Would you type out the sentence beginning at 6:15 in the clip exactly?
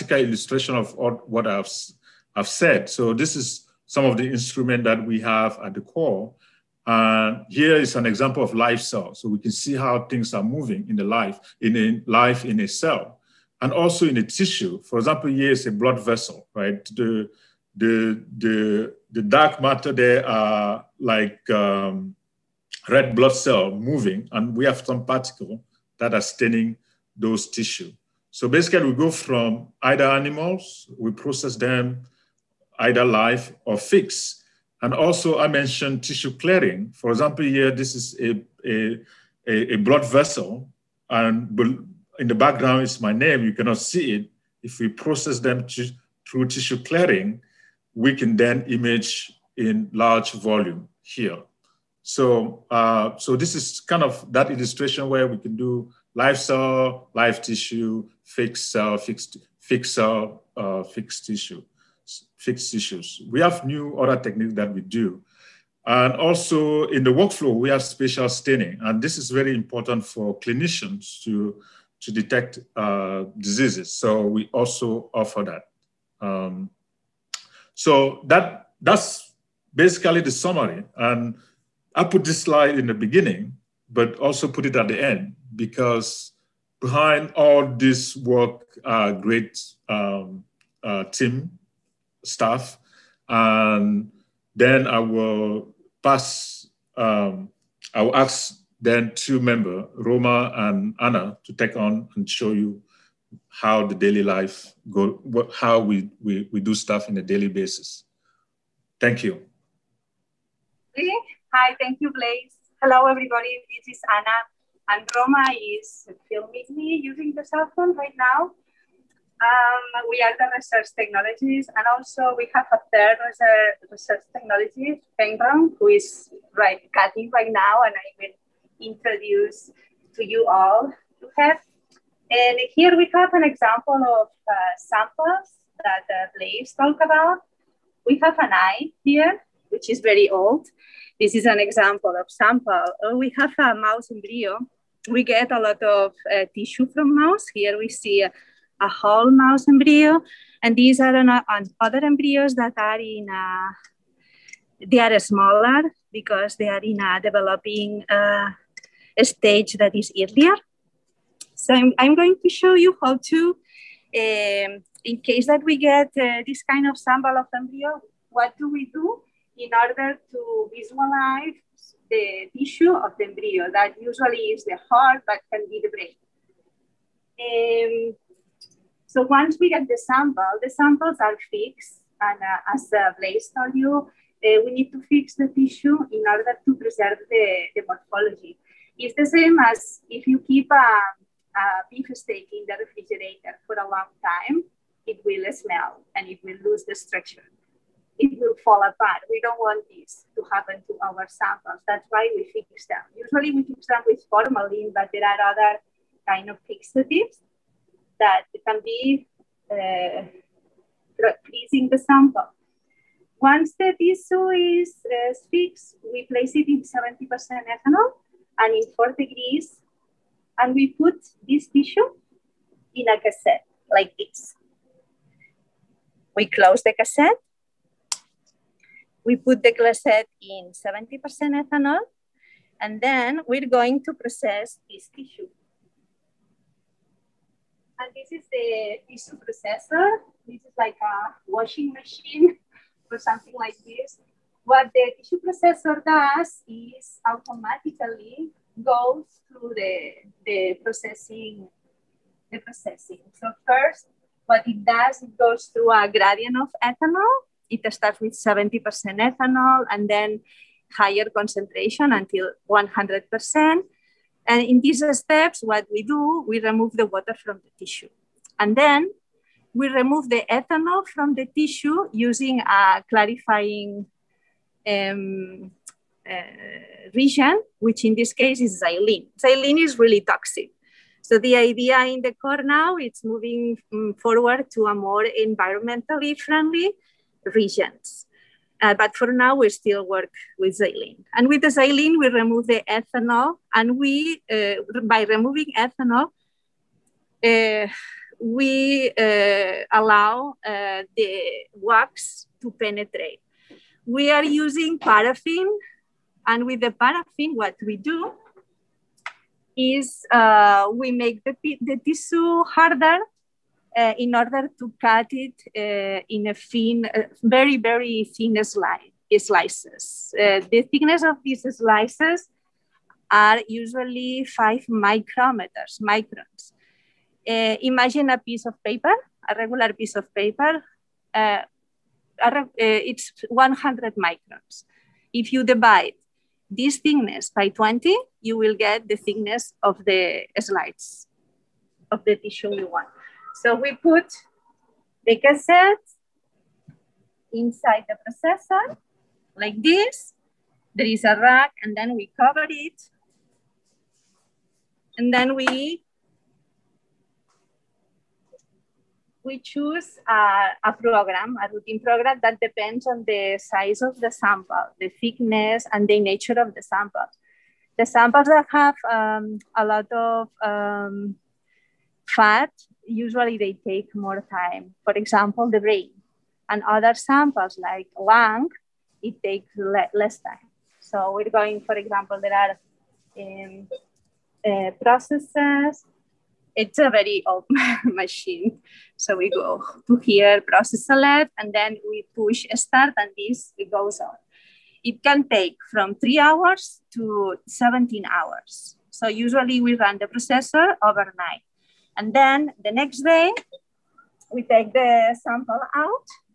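For example, the brain and other samples like lung, it takes le- less time.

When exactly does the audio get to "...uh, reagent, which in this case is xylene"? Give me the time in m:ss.
4:36.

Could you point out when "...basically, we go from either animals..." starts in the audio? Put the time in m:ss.
0:28.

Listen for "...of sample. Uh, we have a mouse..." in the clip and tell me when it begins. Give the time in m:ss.
2:22.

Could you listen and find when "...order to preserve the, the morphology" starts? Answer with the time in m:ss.
3:06.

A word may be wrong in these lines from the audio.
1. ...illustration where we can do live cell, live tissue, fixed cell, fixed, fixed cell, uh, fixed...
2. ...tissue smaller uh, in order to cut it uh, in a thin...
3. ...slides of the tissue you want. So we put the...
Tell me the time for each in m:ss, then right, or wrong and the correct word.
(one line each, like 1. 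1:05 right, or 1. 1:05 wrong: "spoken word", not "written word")
1. 0:54 right
2. 5:12 wrong: "harder", not "smaller"
3. 5:40 right.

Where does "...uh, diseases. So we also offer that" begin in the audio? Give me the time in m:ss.
1:12.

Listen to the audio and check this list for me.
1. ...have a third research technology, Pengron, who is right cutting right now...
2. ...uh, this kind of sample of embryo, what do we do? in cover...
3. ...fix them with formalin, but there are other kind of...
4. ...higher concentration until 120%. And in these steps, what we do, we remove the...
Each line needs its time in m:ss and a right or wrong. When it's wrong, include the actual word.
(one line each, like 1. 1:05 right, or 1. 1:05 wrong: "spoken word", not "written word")
1. 2:02 right
2. 2:46 wrong: "order", not "cover"
3. 3:23 right
4. 4:20 wrong: "100", not "120".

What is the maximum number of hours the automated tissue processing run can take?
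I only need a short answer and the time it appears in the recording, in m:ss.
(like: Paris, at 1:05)
17 hours, at 6:37.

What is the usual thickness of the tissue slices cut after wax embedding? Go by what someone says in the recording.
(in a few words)
5 microns.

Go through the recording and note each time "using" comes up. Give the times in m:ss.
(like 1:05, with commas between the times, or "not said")
1:57, 4:32, 5:04.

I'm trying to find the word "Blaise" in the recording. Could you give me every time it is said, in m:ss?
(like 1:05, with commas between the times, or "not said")
1:52, 2:16, 3:03.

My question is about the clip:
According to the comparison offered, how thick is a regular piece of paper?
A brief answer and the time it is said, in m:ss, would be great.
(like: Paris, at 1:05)
100 microns, at 5:33.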